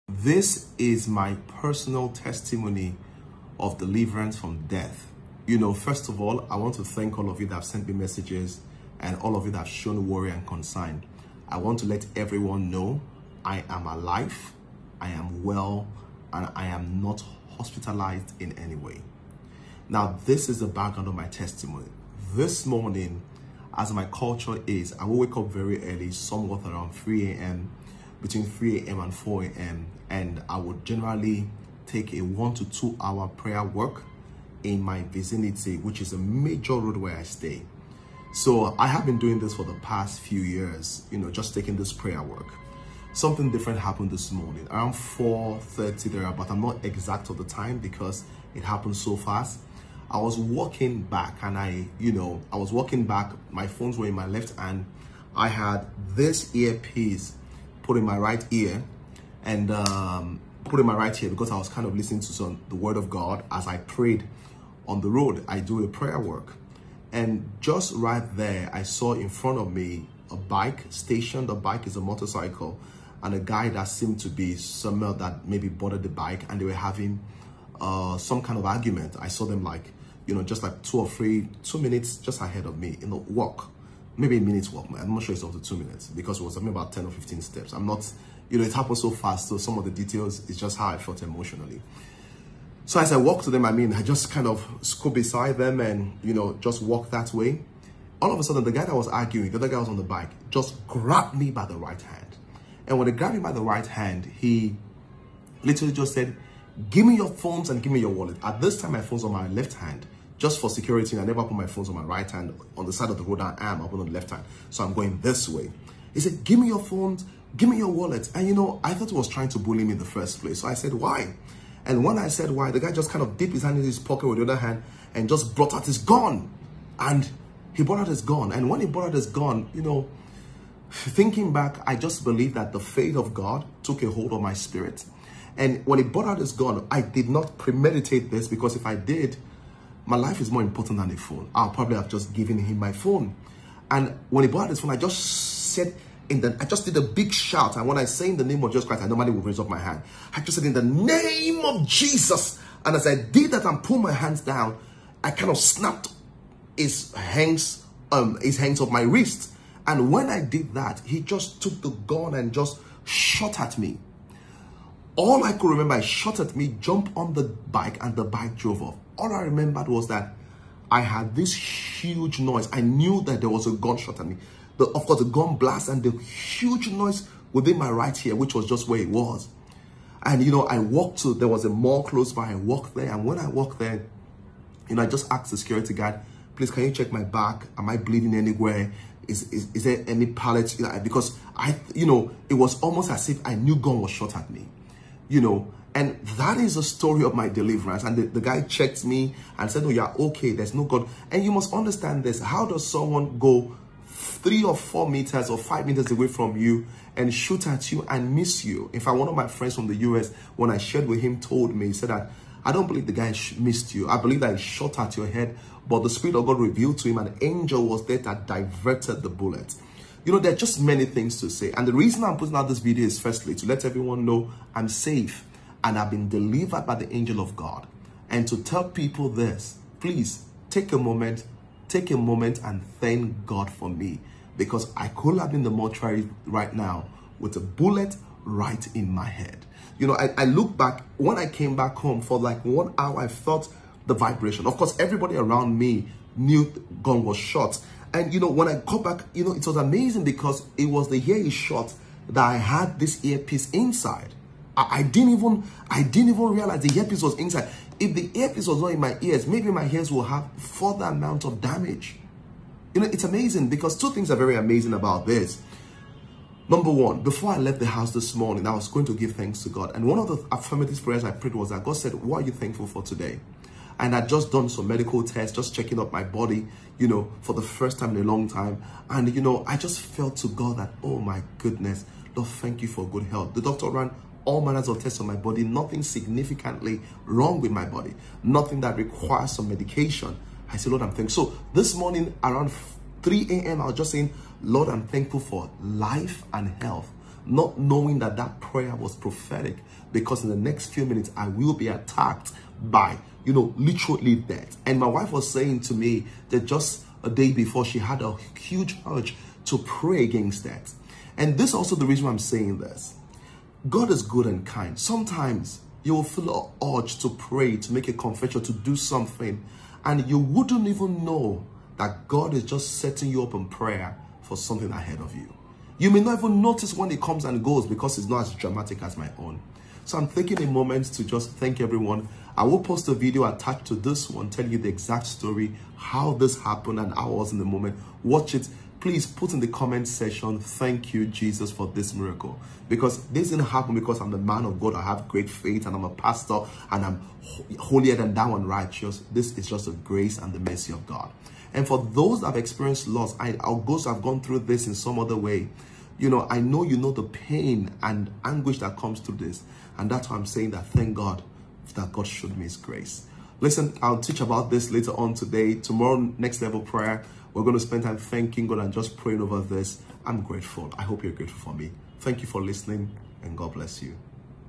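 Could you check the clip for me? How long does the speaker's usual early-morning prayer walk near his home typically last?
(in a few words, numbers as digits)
1 to 2 hours.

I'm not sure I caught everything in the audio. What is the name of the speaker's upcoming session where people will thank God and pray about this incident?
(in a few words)
Next Level Prayer.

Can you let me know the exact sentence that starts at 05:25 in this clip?
You may not even notice when it comes and goes because it's not as dramatic as my own.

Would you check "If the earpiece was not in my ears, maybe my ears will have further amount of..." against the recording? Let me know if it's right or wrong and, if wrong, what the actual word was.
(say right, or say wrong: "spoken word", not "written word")
right.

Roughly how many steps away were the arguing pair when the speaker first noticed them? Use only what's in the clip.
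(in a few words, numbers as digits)
10 or 15.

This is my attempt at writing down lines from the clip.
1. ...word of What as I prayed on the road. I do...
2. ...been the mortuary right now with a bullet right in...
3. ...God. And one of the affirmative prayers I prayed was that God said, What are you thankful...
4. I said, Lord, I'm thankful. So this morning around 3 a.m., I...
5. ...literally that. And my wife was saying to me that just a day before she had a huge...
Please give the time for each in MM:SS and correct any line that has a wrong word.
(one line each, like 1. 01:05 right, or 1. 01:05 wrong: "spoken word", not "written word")
1. 01:02 wrong: "God", not "What"
2. 03:55 right
3. 04:29 right
4. 04:50 right
5. 05:03 right.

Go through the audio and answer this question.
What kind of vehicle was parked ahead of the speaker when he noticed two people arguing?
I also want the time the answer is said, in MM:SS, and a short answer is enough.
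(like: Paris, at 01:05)
motorcycle, at 01:11.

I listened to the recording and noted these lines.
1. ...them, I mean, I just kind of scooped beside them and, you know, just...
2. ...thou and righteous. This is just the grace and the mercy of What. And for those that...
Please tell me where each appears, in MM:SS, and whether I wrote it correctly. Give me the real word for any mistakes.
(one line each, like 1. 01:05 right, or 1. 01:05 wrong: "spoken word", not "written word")
1. 01:33 right
2. 05:48 wrong: "God", not "What".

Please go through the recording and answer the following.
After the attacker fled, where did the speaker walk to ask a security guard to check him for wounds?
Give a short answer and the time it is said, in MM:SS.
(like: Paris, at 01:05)
a mall, at 03:01.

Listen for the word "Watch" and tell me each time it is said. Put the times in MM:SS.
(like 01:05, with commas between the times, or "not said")
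05:38.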